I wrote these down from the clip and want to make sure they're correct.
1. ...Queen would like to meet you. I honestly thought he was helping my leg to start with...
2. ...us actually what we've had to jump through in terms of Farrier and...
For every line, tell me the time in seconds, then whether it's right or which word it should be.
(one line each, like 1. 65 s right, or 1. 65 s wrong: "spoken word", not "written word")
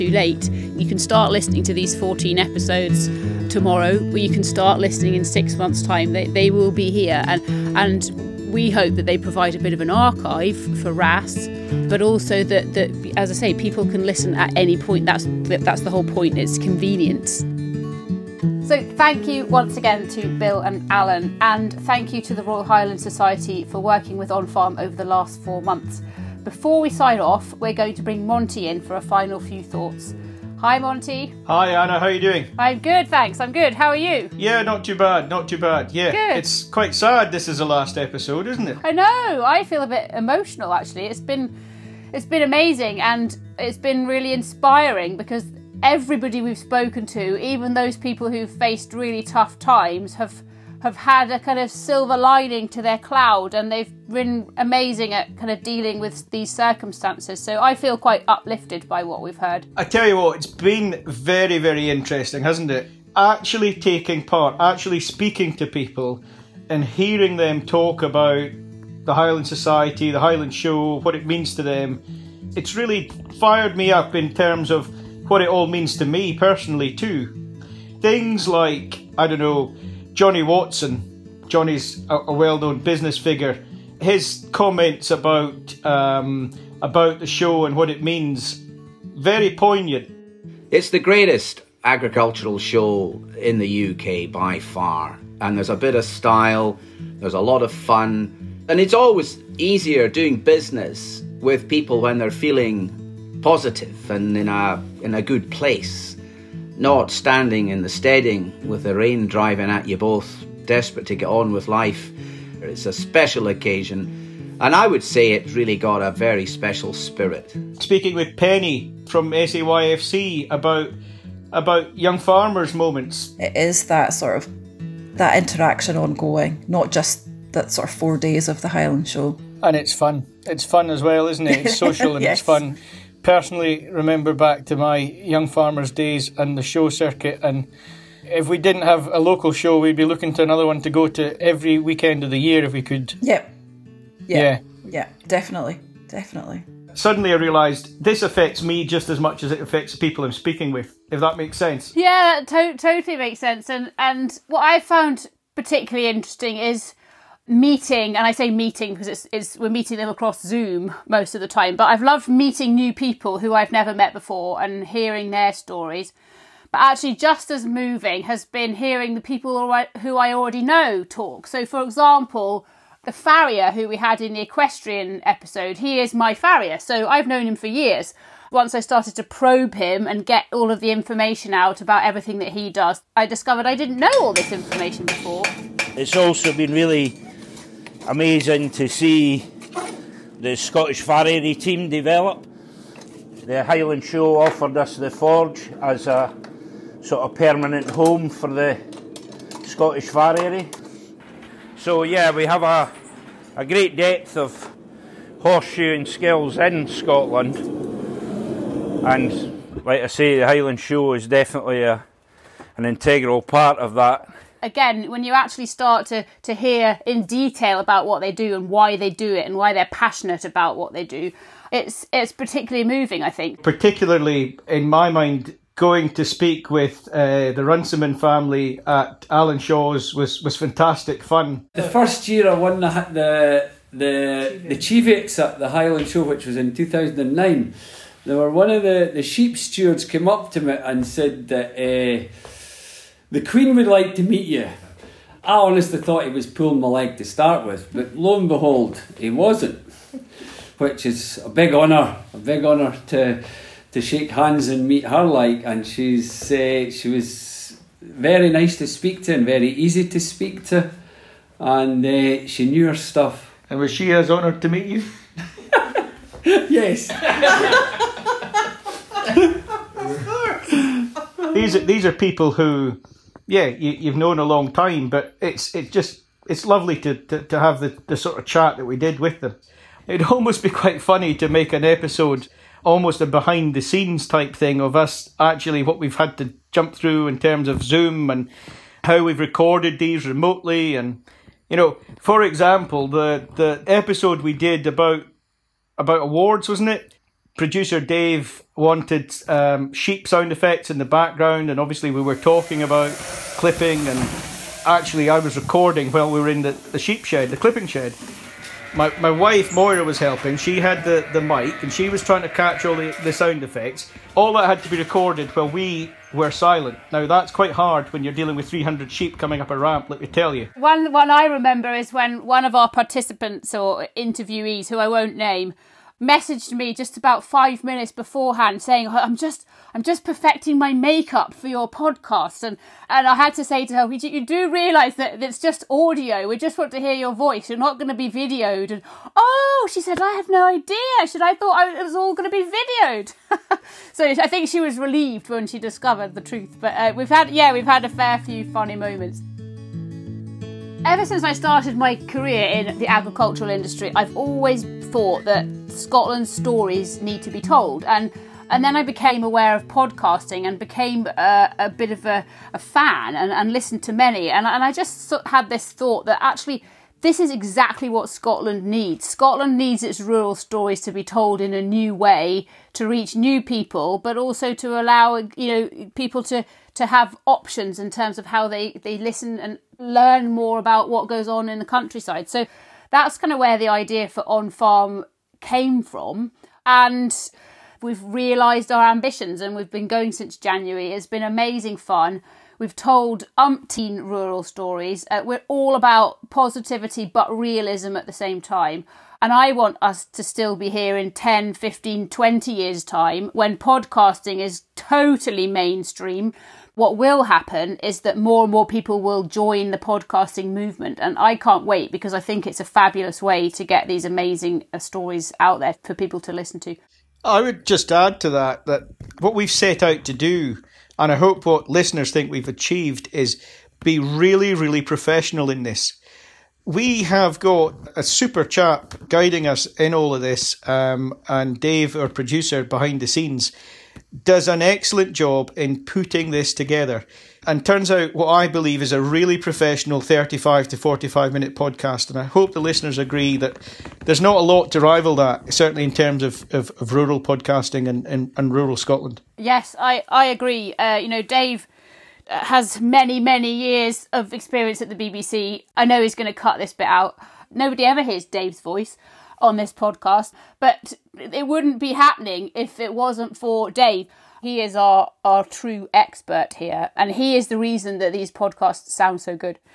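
1. 243 s wrong: "pulling", not "helping"
2. 284 s wrong: "Zoom", not "Farrier".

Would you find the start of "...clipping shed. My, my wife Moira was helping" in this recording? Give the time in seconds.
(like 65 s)
307 s.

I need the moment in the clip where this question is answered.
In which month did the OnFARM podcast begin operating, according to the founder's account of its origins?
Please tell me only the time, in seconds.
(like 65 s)
390 s.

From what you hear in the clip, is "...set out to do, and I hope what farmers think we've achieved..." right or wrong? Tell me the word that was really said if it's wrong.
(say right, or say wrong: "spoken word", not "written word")
wrong: "listeners", not "farmers".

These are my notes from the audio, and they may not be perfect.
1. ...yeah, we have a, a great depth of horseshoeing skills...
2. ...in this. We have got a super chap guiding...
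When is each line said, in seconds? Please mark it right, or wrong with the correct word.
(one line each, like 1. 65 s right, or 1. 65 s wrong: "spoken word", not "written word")
1. 202 s right
2. 425 s right.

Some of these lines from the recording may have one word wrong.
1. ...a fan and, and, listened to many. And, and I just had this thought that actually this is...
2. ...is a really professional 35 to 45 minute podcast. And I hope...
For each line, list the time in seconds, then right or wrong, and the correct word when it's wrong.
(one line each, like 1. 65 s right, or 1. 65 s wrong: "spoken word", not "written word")
1. 362 s right
2. 439 s right.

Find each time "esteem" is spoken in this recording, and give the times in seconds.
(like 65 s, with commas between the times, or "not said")
not said.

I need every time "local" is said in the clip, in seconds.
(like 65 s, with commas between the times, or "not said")
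139 s.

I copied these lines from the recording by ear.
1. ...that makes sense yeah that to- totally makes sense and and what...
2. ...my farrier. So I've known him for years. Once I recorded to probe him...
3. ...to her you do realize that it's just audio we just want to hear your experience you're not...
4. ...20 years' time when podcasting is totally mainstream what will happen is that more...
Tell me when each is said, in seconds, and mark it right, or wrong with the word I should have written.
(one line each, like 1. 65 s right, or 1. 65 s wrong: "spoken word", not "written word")
1. 151 s right
2. 176 s wrong: "started", not "recorded"
3. 333 s wrong: "voice", not "experience"
4. 402 s right.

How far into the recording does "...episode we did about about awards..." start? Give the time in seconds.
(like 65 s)
293 s.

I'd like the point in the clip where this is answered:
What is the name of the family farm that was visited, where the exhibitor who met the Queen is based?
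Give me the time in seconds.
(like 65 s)
229 s.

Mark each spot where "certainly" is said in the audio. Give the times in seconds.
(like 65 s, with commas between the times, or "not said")
445 s.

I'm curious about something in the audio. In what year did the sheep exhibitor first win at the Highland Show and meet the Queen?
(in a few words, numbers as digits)
2009.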